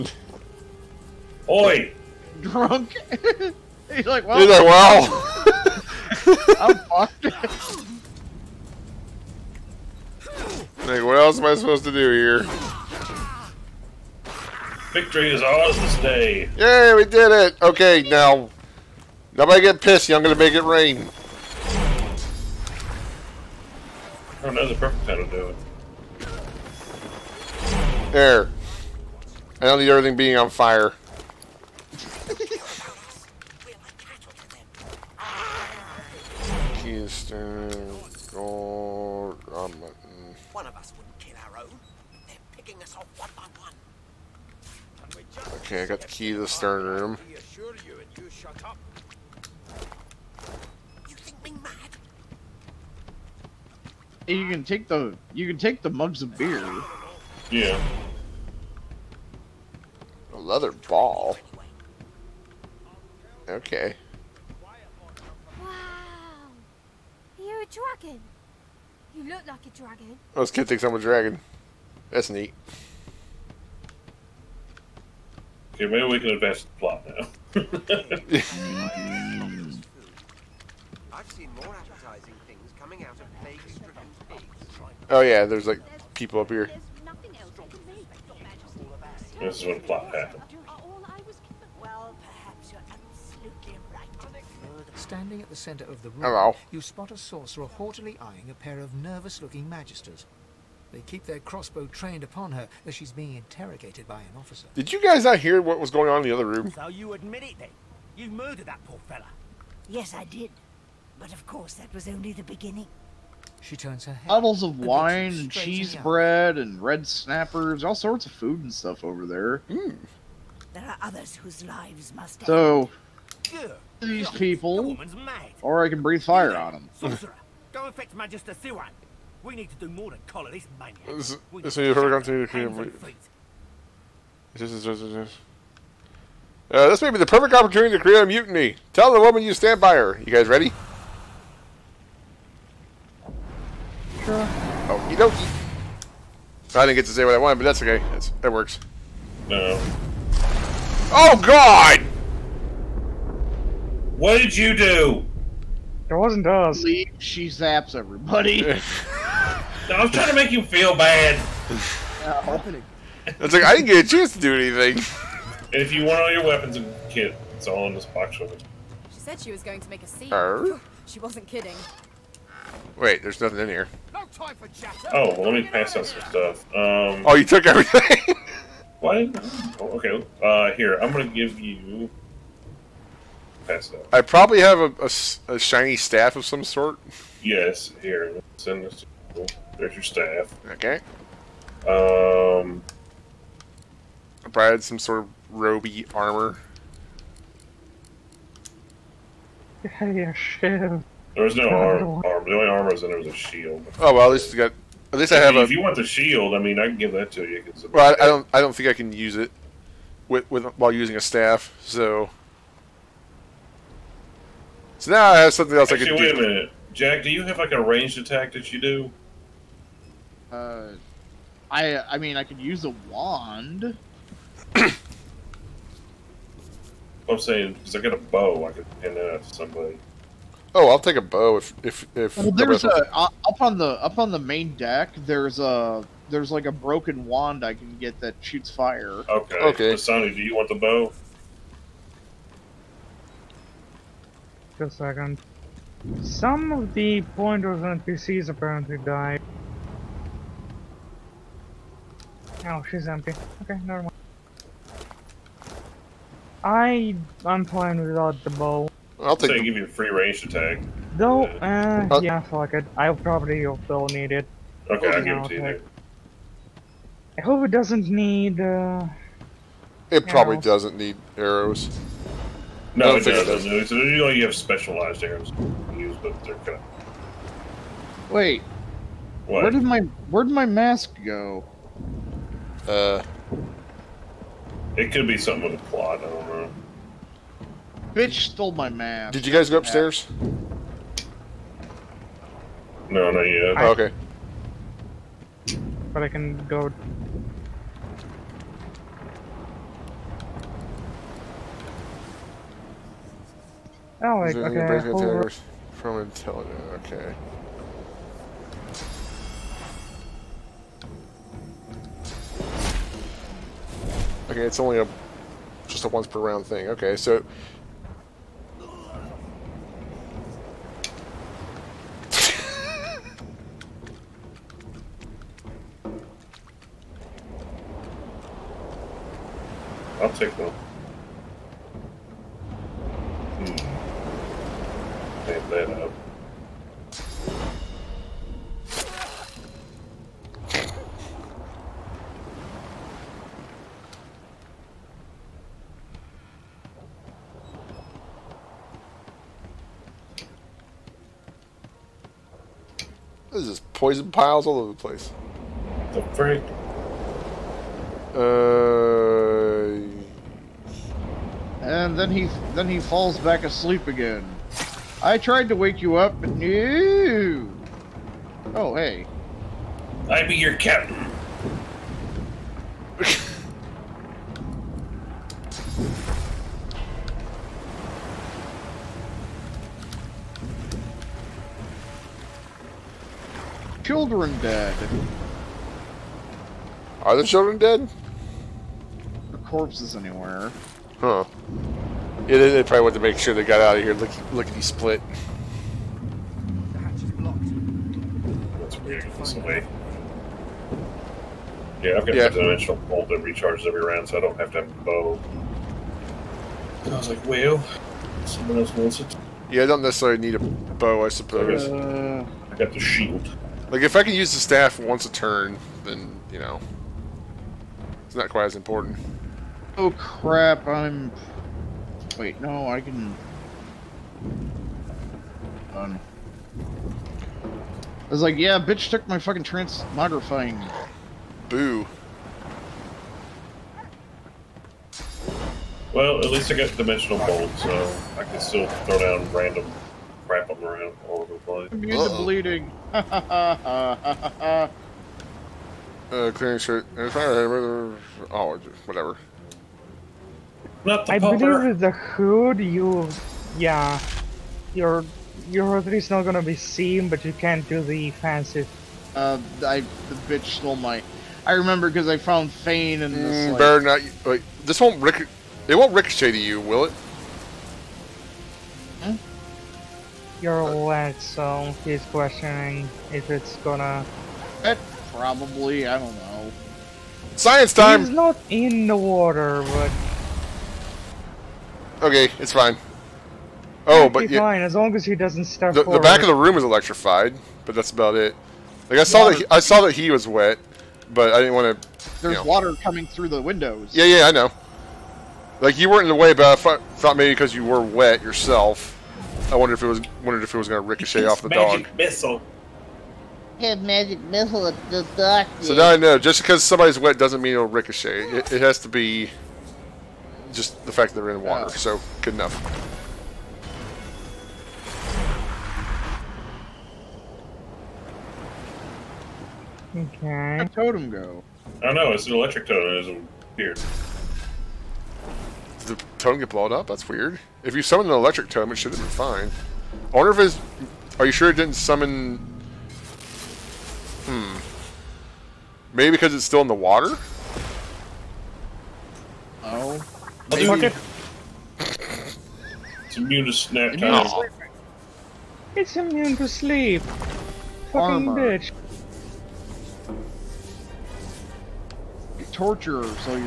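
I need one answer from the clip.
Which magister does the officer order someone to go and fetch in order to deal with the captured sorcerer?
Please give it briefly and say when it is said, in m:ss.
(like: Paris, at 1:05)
Magister Siwan, at 2:08.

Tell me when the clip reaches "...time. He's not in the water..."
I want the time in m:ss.
7:57.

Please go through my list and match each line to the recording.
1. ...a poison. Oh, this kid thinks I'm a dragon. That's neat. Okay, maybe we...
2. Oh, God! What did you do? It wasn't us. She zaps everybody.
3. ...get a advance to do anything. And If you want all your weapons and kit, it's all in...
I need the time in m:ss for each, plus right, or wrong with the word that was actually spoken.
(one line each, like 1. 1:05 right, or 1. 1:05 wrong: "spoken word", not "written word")
1. 1:09 wrong: "dragon", not "poison"
2. 2:31 right
3. 2:43 wrong: "chance", not "advance".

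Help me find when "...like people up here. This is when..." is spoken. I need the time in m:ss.
1:25.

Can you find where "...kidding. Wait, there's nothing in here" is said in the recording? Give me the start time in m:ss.
2:51.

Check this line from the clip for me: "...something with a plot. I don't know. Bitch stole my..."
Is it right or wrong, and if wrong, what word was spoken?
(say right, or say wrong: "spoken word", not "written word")
right.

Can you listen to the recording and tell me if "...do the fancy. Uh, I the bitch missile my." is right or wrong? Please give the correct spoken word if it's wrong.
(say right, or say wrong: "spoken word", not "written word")
wrong: "stole", not "missile".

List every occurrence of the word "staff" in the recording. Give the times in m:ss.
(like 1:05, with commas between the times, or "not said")
3:05, 3:10, 3:31, 6:54.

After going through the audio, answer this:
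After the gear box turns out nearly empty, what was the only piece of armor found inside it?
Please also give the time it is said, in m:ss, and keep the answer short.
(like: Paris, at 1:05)
A shield, at 3:23.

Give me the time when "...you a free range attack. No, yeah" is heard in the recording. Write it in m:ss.
4:19.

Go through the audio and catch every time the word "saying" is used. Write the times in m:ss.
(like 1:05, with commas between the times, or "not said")
3:47.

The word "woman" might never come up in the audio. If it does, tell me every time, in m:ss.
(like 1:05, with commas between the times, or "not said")
2:19.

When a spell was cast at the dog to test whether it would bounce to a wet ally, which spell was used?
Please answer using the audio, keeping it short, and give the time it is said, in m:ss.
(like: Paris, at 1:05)
Magic missile, at 8:23.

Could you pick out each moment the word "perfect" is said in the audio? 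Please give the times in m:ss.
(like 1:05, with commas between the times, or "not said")
0:24, 2:17.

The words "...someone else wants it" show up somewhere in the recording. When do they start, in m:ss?
6:48.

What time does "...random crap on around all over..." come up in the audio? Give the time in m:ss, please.
7:19.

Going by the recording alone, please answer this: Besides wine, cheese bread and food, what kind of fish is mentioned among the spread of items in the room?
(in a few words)
Red snappers.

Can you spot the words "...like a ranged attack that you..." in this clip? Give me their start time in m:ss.
3:37.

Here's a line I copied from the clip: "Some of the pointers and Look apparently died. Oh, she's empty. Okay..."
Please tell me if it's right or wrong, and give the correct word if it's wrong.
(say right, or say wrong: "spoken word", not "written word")
wrong: "PCs", not "Look".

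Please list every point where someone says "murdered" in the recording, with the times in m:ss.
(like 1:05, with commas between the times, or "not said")
1:48.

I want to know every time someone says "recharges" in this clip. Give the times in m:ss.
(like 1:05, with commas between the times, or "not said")
6:43.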